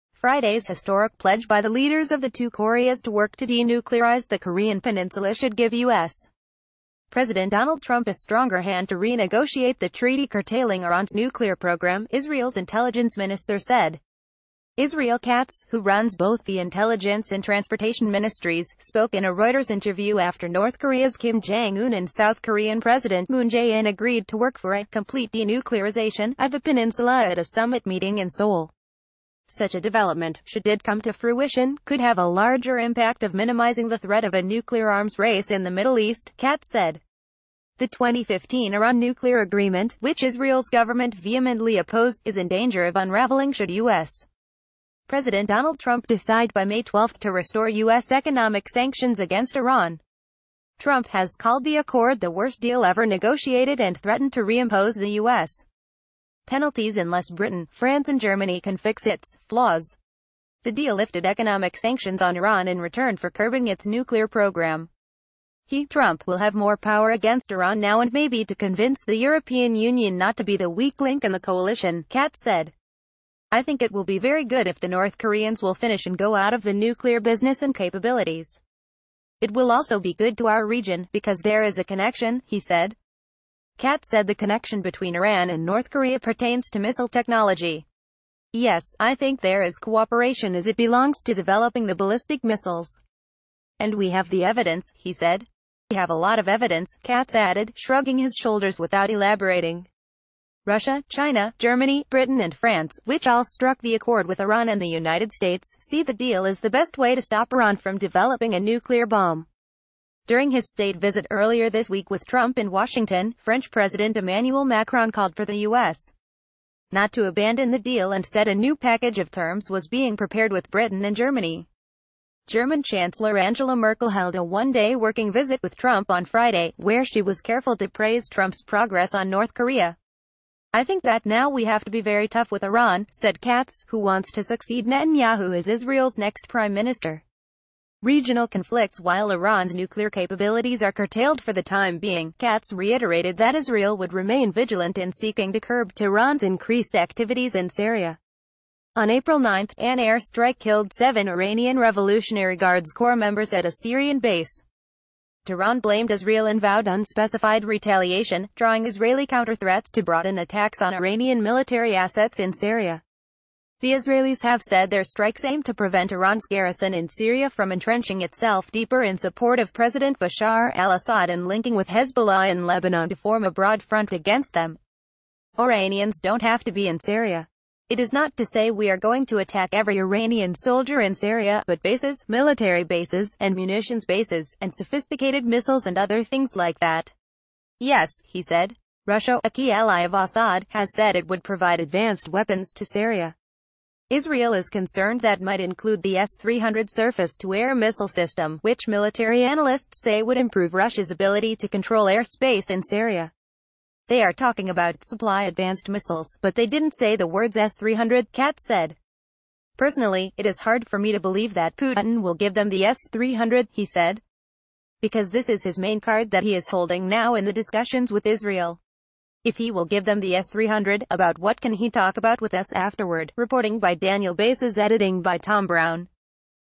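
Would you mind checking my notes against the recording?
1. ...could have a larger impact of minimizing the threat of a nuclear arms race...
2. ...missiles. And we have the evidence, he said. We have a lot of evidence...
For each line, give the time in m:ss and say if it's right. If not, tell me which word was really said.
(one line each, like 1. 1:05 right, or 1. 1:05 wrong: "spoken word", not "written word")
1. 0:31 right
2. 1:32 right.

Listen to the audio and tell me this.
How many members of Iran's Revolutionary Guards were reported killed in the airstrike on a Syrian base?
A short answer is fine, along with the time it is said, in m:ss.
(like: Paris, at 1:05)
7, at 2:30.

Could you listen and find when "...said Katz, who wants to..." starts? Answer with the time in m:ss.
2:13.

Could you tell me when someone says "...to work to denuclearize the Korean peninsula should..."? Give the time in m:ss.
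0:03.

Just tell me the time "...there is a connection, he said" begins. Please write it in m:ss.
1:21.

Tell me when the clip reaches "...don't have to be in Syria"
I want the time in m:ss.
2:56.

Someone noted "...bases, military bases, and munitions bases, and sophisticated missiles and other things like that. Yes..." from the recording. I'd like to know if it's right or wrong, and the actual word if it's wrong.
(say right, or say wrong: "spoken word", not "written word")
right.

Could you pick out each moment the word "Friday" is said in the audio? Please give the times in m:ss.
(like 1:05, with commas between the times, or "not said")
0:00, 2:06.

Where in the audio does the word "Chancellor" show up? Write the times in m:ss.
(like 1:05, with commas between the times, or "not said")
2:02.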